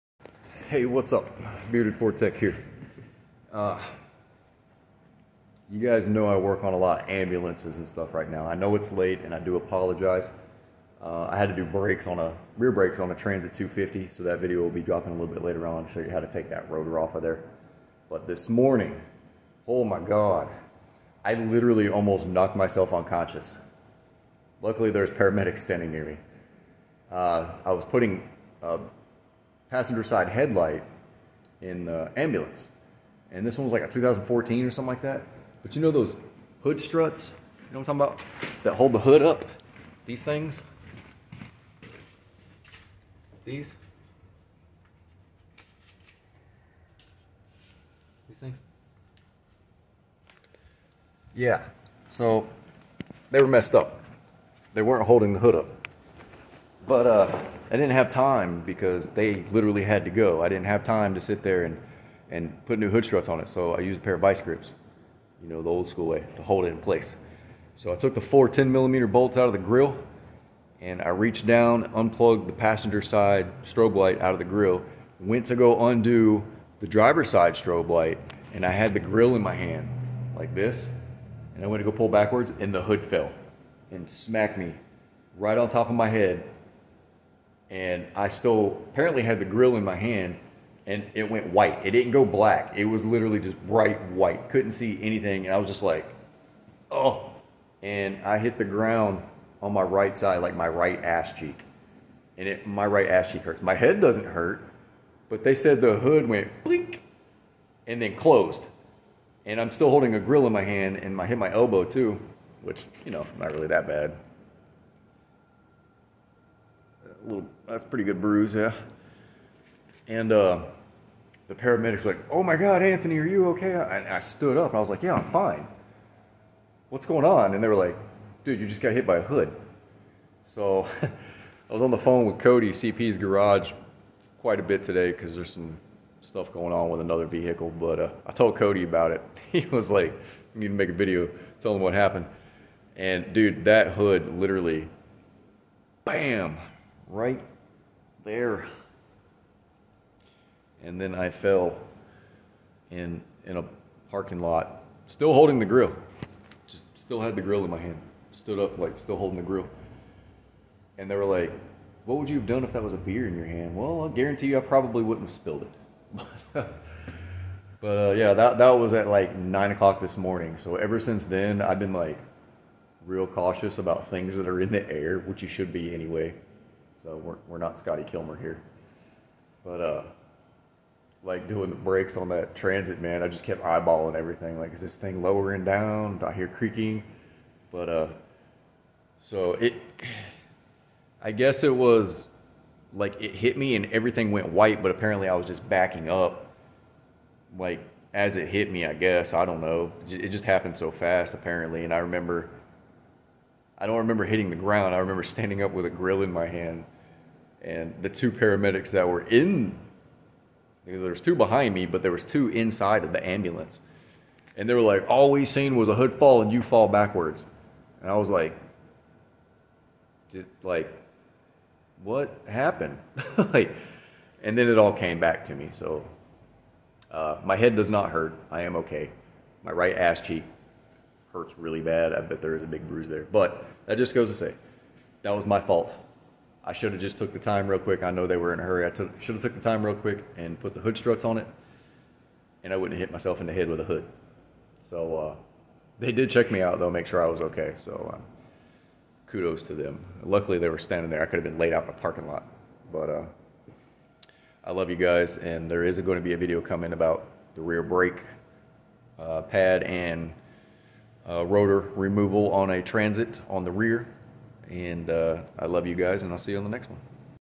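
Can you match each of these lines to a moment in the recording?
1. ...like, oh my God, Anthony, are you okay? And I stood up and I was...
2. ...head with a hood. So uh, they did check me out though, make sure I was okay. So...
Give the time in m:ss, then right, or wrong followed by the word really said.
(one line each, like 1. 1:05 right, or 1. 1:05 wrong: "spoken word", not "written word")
1. 2:02 right
2. 4:03 right.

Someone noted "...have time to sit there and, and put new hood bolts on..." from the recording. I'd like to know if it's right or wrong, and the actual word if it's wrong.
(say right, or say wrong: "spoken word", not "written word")
wrong: "struts", not "bolts".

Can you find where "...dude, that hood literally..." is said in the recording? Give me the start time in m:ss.
2:23.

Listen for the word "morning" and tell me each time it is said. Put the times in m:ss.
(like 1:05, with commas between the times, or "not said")
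0:18, 2:50.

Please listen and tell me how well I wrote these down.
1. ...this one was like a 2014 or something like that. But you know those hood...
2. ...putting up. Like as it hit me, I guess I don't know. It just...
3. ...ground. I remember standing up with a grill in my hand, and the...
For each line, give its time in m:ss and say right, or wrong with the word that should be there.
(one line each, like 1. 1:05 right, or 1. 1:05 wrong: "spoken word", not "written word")
1. 0:33 right
2. 3:15 wrong: "backing", not "putting"
3. 3:24 right.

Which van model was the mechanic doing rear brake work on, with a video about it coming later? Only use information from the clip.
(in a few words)
Transit 250.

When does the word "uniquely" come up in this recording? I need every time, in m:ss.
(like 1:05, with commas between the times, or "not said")
not said.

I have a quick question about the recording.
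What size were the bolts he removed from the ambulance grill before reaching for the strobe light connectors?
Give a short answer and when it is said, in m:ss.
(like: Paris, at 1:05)
10 millimeter, at 1:08.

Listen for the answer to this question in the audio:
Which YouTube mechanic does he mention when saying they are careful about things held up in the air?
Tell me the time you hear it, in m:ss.
2:57.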